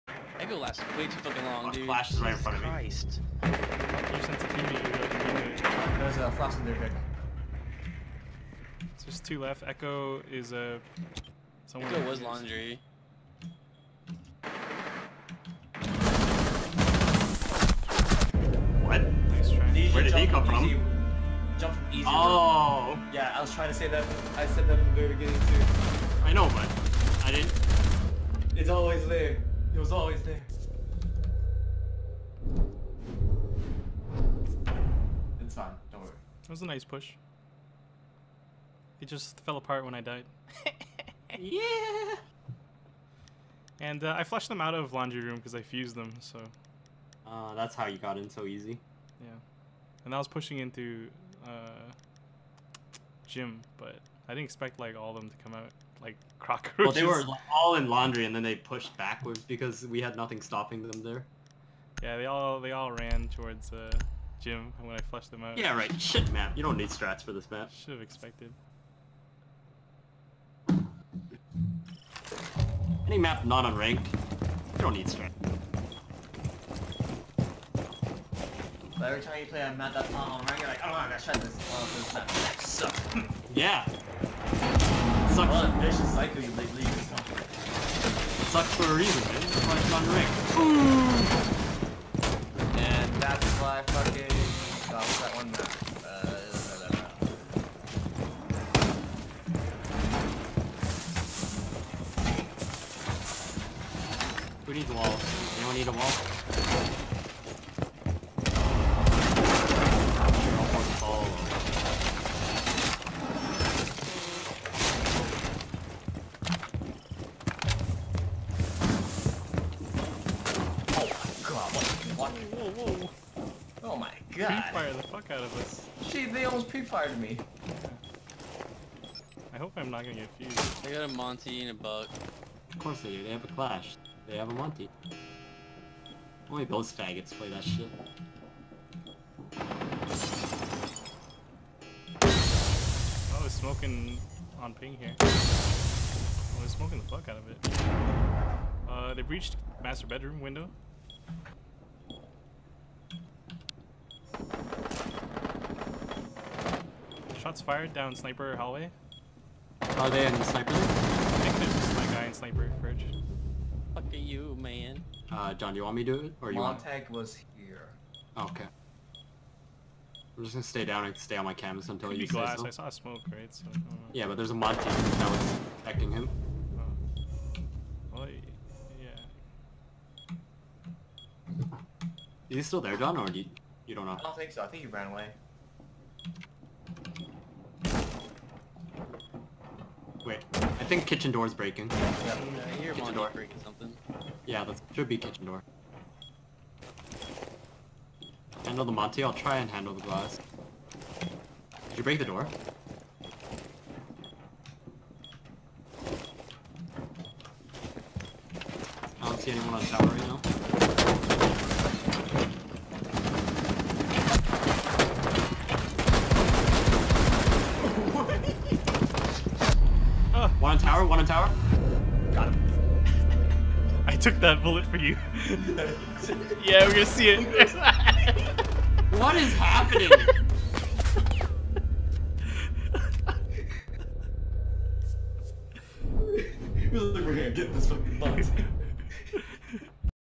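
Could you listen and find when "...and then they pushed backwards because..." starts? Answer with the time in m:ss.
0:58.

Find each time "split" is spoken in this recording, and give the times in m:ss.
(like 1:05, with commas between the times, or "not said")
not said.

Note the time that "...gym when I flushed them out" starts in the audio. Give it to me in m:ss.
1:04.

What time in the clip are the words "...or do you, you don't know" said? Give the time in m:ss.
3:03.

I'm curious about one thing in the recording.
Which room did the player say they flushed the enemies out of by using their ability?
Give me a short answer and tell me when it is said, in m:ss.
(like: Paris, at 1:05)
Laundry room, at 0:44.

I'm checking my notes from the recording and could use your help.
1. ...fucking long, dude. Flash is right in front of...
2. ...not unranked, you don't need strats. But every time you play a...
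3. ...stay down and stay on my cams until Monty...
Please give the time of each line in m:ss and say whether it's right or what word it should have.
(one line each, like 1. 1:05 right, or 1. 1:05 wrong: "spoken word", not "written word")
1. 0:01 right
2. 1:13 right
3. 2:50 wrong: "Could", not "Monty".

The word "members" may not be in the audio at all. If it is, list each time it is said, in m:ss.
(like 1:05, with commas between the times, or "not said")
not said.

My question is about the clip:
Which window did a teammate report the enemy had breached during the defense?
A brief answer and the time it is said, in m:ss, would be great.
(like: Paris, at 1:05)
Master bedroom window, at 2:29.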